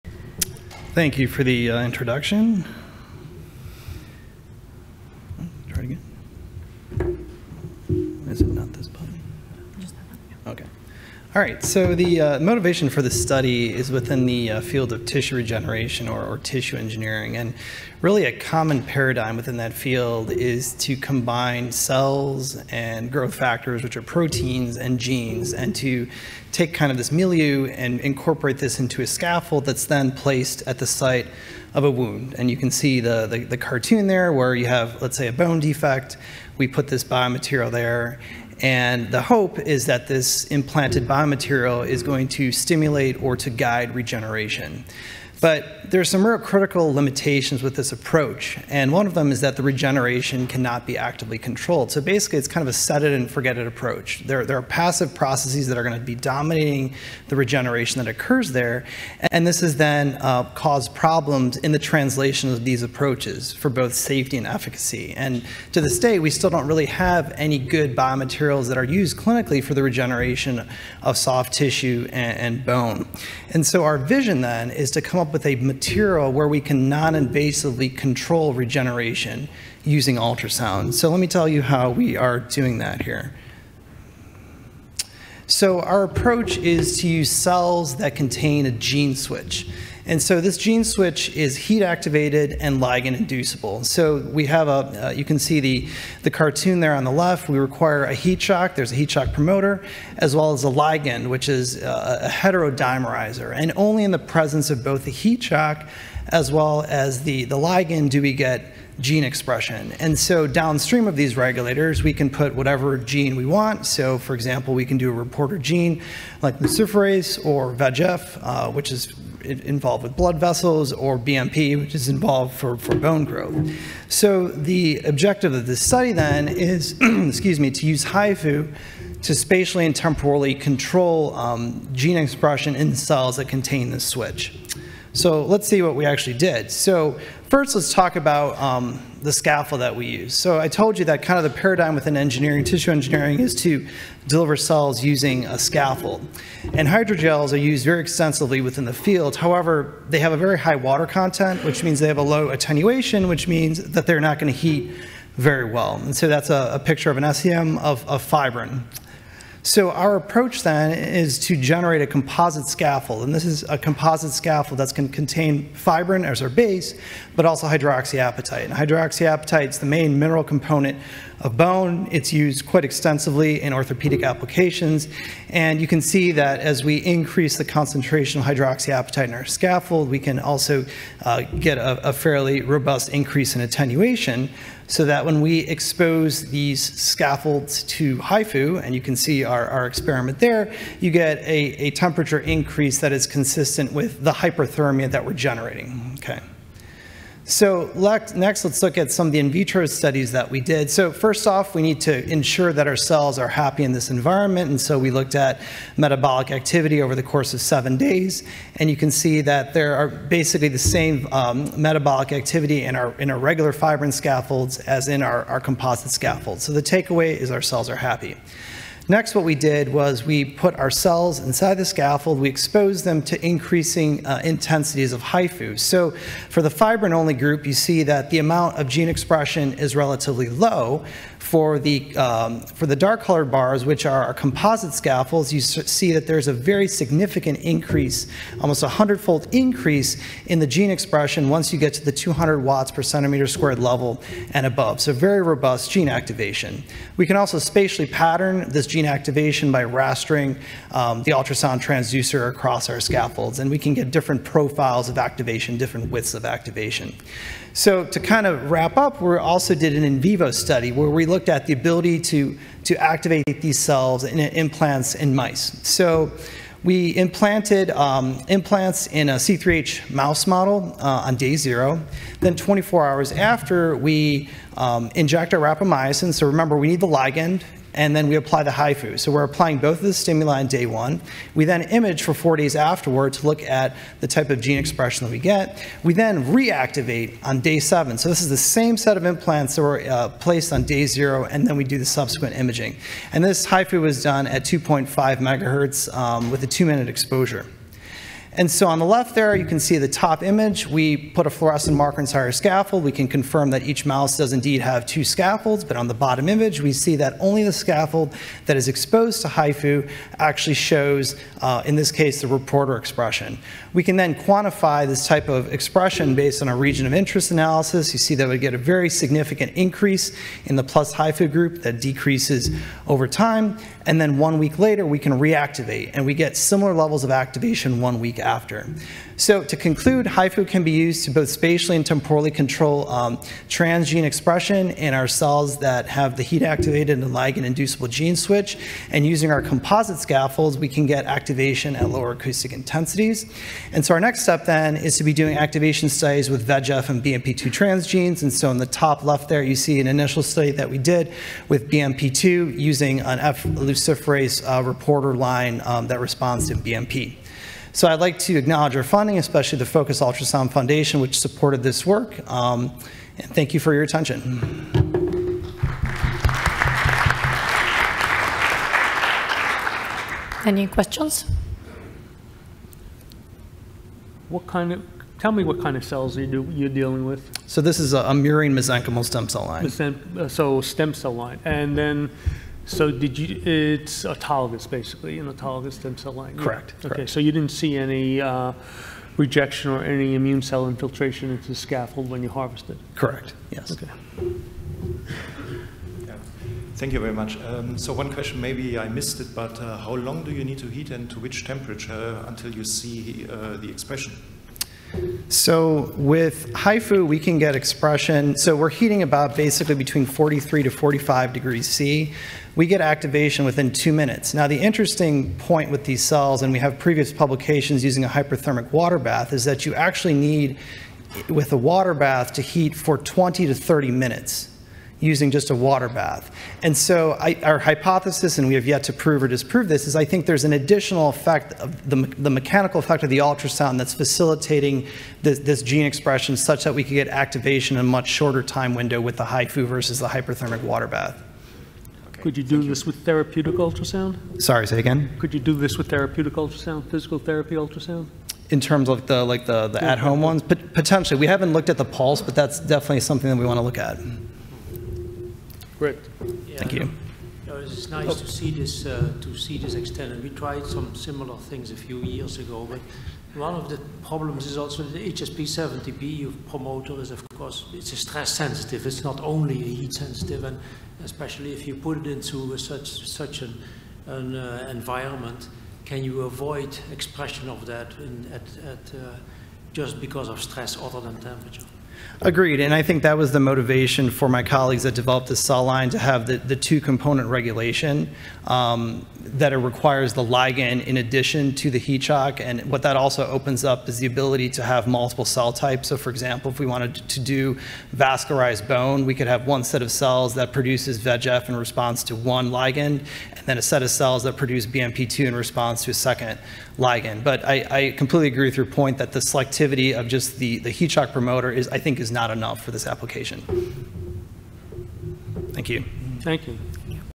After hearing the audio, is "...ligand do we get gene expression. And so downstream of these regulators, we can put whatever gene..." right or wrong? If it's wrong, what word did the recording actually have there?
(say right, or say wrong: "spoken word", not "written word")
right.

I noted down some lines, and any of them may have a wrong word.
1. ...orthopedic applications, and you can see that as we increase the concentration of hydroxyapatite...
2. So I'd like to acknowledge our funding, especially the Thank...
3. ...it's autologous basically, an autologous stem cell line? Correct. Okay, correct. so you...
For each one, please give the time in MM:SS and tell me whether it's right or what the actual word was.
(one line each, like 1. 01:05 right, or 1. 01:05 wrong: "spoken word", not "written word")
1. 02:53 right
2. 05:57 wrong: "Focus", not "Thank"
3. 06:23 right.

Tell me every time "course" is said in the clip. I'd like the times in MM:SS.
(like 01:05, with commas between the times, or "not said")
03:27, 07:47.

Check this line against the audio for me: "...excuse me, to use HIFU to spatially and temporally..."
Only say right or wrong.
right.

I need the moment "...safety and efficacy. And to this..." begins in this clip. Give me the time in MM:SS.
01:03.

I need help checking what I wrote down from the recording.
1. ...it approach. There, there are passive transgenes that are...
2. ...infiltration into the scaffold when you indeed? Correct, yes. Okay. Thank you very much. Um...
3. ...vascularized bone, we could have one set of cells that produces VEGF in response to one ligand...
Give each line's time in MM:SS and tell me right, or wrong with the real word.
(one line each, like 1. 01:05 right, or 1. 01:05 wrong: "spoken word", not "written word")
1. 00:53 wrong: "processes", not "transgenes"
2. 06:30 wrong: "harvested", not "indeed"
3. 08:18 right.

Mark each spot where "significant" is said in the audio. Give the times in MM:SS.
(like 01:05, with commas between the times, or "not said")
03:56, 05:19.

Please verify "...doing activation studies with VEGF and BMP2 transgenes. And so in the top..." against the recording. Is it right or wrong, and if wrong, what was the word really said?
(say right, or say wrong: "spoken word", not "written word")
right.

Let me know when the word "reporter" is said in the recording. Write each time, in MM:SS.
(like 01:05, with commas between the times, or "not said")
01:55, 05:12, 05:54.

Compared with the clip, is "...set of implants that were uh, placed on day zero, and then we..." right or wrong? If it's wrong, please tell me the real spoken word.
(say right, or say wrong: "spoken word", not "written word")
right.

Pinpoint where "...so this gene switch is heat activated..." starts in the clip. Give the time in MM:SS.
01:30.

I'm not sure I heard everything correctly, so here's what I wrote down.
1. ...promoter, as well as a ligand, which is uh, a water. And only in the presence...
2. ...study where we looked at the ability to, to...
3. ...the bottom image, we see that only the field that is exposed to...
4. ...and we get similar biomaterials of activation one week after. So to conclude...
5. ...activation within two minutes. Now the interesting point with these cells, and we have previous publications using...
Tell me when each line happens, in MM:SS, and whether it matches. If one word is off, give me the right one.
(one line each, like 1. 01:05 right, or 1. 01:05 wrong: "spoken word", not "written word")
1. 01:39 wrong: "heterodimerizer", not "water"
2. 04:20 right
3. 05:06 wrong: "scaffold", not "field"
4. 05:26 wrong: "levels", not "biomaterials"
5. 06:53 right.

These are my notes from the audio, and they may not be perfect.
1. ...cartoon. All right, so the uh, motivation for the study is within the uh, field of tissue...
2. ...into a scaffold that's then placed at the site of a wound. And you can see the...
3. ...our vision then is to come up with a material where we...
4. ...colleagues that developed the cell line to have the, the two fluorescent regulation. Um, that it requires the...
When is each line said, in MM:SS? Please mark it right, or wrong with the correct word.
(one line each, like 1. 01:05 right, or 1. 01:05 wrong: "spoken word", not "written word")
1. 00:01 wrong: "introduction", not "cartoon"
2. 00:28 right
3. 01:13 right
4. 08:04 wrong: "component", not "fluorescent".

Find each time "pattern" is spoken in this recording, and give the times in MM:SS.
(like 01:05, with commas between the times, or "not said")
04:08.